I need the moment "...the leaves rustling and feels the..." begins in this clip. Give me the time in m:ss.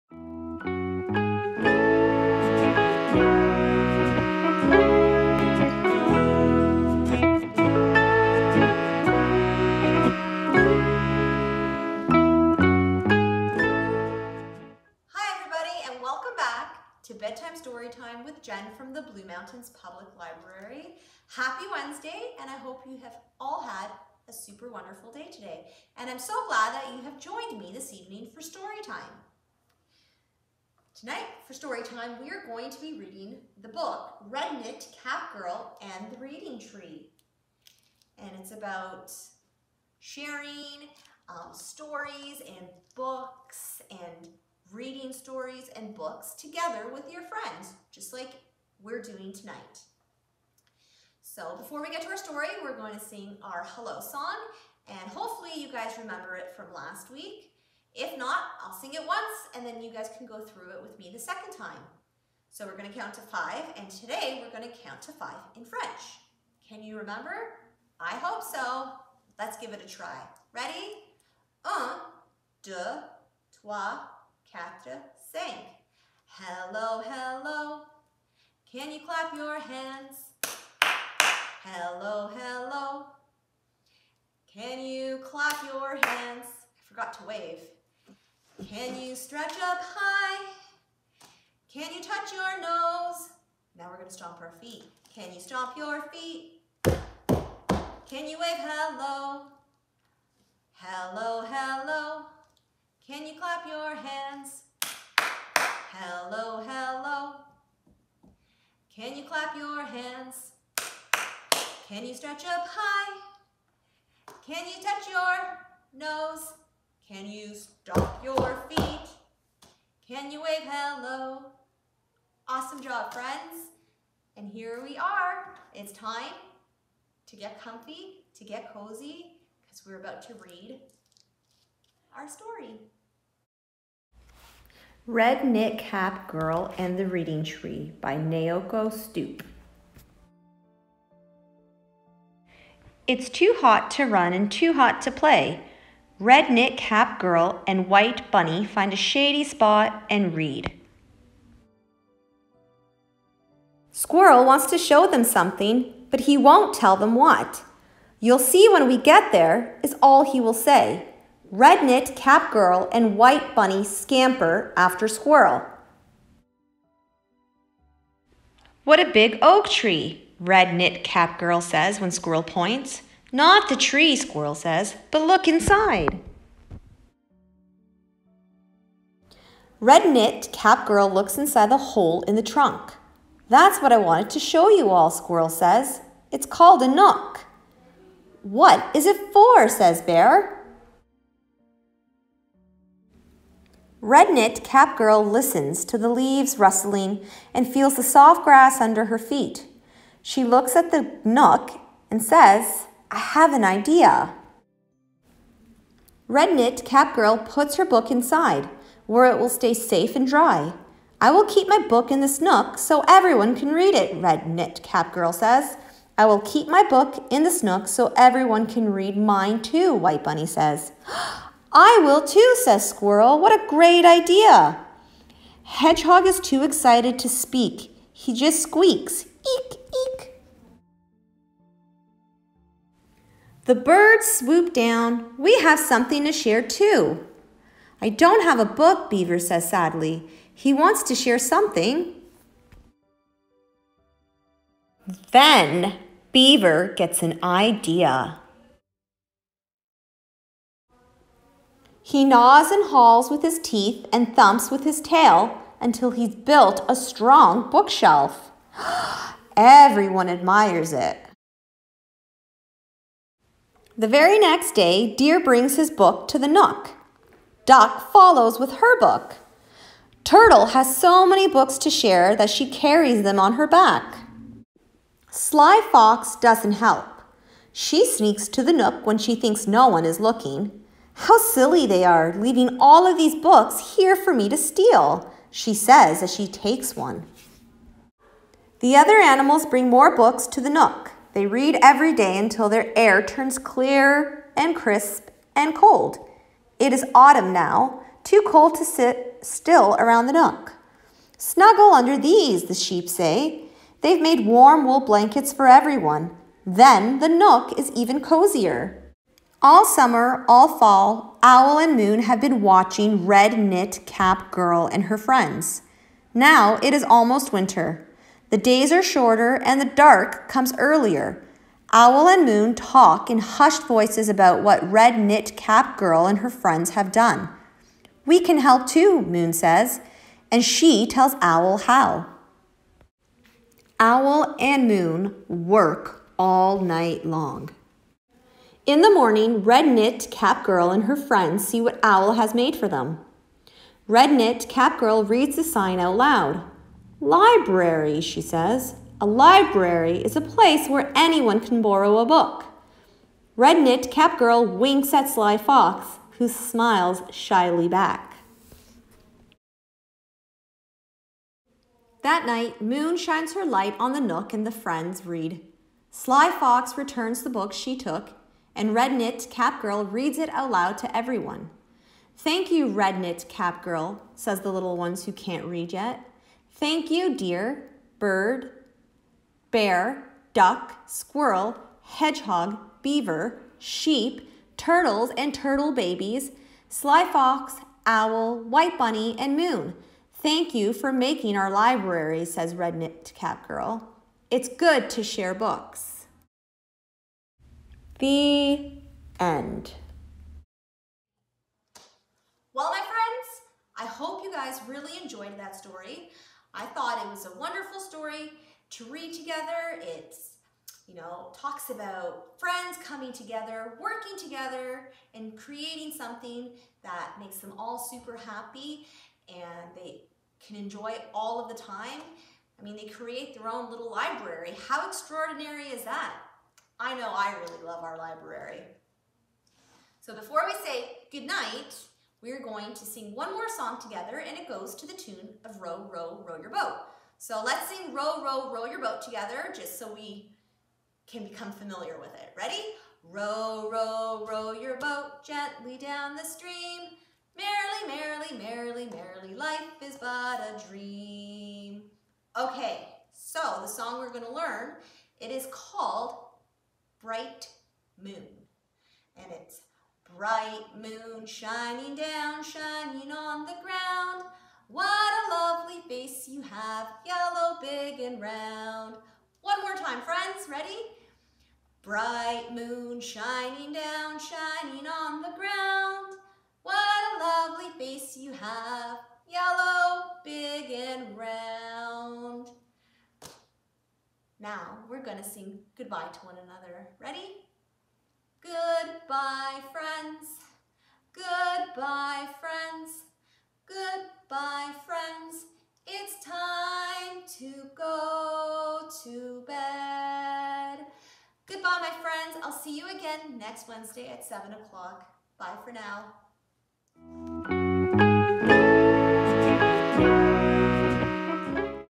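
3:15.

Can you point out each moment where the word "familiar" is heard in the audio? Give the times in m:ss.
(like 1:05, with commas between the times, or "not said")
7:21.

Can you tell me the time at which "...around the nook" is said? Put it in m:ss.
4:59.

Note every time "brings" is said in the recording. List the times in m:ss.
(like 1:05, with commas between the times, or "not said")
4:25, 4:49.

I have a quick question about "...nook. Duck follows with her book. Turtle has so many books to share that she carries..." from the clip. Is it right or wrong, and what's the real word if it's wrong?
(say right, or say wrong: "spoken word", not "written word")
right.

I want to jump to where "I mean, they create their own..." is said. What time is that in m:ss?
7:02.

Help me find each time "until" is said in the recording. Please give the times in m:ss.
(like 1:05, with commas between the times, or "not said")
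4:15, 4:52.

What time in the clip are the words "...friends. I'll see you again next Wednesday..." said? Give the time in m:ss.
8:22.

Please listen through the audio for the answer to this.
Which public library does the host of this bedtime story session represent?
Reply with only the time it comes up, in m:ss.
0:19.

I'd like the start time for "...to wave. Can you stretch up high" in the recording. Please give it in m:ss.
1:27.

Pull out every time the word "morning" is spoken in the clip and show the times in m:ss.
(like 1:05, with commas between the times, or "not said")
5:39.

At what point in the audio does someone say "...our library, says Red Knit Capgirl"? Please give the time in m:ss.
6:31.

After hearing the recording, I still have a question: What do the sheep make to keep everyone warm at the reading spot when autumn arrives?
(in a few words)
wool blankets.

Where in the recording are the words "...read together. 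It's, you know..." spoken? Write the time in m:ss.
6:49.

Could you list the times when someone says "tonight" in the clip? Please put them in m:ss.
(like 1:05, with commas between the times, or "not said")
0:30, 0:49.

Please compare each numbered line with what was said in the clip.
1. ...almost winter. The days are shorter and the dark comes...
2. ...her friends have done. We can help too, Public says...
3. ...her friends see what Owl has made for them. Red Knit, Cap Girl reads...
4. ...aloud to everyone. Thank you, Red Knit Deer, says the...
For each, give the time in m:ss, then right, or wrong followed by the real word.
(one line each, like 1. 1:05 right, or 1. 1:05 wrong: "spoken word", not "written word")
1. 5:17 right
2. 5:26 wrong: "Moon", not "Public"
3. 5:41 right
4. 6:10 wrong: "Capgirl", not "Deer".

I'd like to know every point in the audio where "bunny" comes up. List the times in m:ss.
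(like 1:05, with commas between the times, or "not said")
2:28, 2:43, 3:40, 6:28.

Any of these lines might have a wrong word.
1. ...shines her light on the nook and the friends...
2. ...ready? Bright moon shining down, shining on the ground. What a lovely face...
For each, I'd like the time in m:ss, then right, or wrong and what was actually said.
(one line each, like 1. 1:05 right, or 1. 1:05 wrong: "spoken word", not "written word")
1. 6:03 right
2. 7:50 right.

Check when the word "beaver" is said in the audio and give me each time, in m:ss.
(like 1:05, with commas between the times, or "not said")
3:59, 4:06, 6:23.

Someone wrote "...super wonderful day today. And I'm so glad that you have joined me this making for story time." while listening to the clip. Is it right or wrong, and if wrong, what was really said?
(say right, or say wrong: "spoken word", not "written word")
wrong: "evening", not "making".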